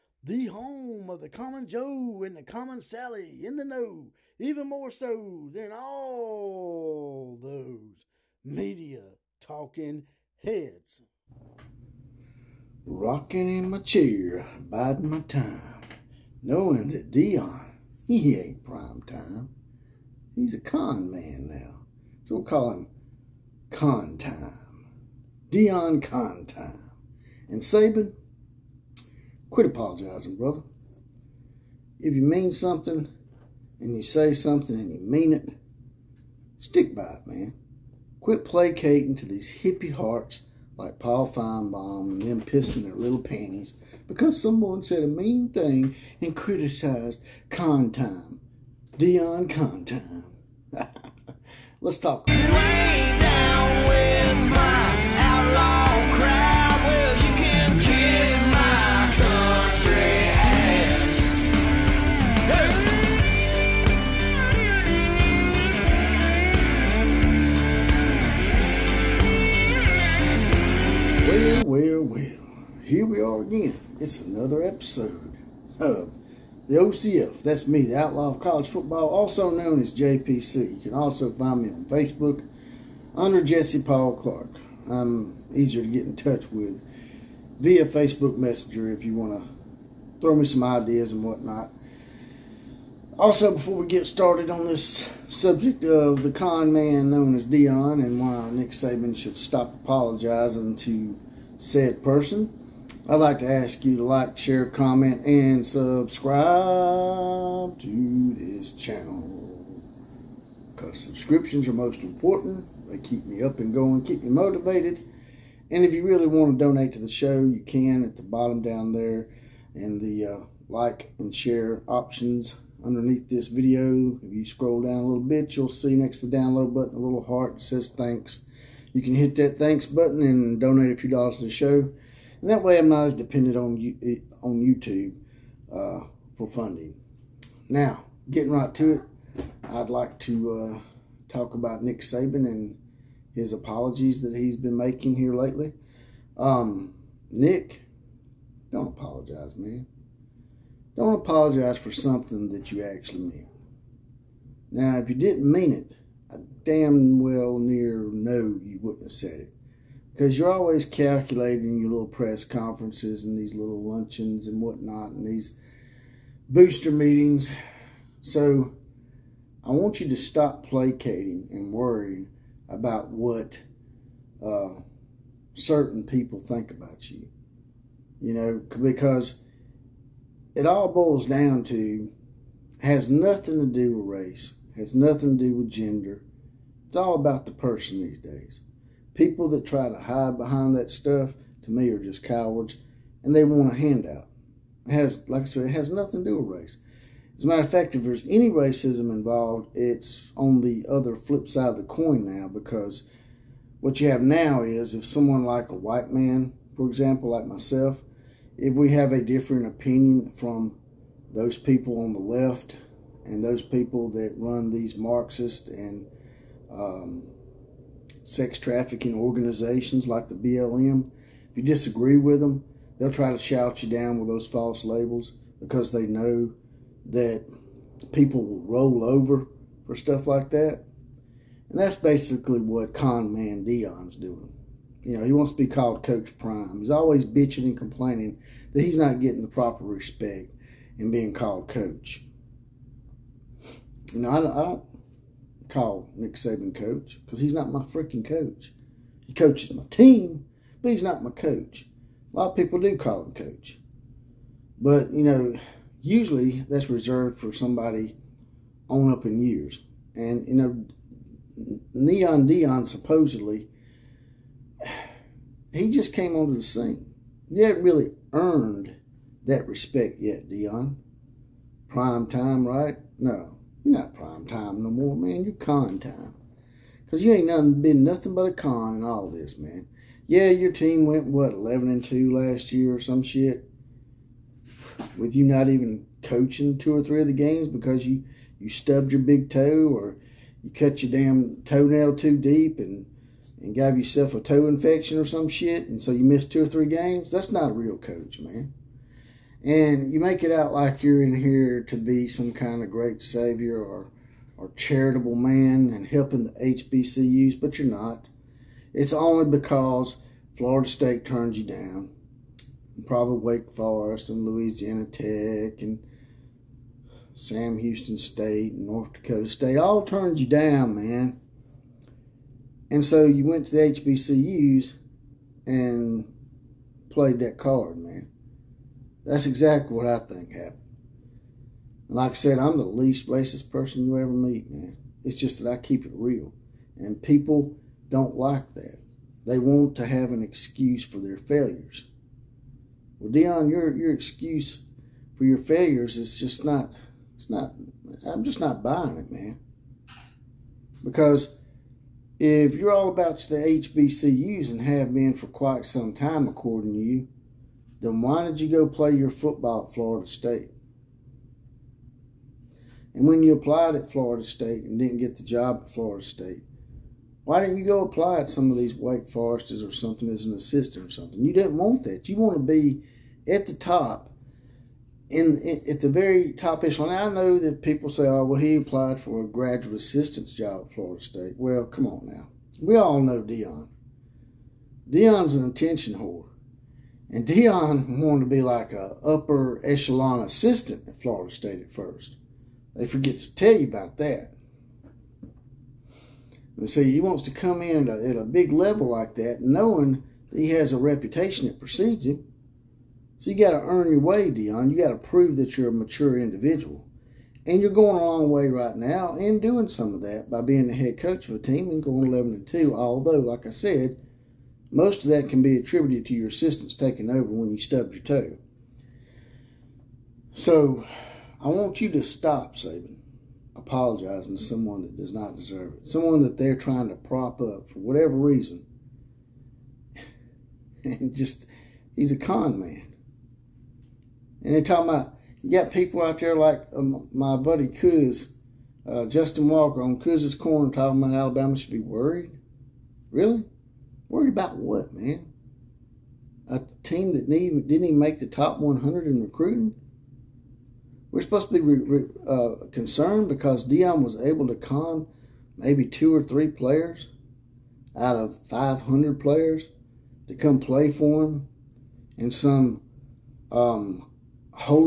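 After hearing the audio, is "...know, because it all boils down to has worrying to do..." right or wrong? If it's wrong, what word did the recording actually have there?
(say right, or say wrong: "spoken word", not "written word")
wrong: "nothing", not "worrying".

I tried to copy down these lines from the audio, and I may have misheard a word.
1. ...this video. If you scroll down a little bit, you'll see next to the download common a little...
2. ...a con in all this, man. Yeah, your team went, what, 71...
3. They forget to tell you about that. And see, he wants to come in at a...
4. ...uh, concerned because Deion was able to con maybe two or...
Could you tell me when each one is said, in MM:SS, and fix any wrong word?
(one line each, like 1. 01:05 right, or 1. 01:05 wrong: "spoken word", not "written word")
1. 02:03 wrong: "button", not "common"
2. 04:38 wrong: "11", not "71"
3. 06:32 right
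4. 07:32 right.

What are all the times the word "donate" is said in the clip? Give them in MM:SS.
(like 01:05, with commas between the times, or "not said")
01:56, 02:10.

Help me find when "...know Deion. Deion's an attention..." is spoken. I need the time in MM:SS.
06:23.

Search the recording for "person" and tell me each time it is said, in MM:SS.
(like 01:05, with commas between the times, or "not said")
01:42, 03:07, 05:33.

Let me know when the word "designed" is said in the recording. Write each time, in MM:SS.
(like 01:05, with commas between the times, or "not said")
not said.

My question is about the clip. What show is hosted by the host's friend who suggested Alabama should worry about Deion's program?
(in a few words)
Kuz's Corner.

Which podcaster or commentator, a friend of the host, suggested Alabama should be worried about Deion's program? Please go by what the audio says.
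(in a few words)
Justin Walker.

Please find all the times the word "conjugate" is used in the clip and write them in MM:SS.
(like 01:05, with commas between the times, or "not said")
not said.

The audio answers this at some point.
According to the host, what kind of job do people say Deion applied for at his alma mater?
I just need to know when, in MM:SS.
06:19.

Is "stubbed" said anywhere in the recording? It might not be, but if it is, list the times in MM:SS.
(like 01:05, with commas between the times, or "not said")
04:48, 06:57.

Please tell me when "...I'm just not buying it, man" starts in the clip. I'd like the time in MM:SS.
05:48.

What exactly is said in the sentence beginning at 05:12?
And probably Wake Forest and Louisiana Tech and Sam Houston State and North Dakota State all turns you down, man.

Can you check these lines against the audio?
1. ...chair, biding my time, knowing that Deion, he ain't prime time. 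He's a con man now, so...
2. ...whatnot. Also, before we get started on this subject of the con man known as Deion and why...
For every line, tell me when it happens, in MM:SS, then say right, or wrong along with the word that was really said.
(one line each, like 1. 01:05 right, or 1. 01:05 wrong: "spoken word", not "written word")
1. 00:13 right
2. 01:31 right.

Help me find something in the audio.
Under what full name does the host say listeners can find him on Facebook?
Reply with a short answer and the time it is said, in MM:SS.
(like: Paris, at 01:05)
Jesse Paul Clark, at 01:23.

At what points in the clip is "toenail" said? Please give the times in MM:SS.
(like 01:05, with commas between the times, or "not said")
04:51.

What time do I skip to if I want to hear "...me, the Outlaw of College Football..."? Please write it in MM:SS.
01:17.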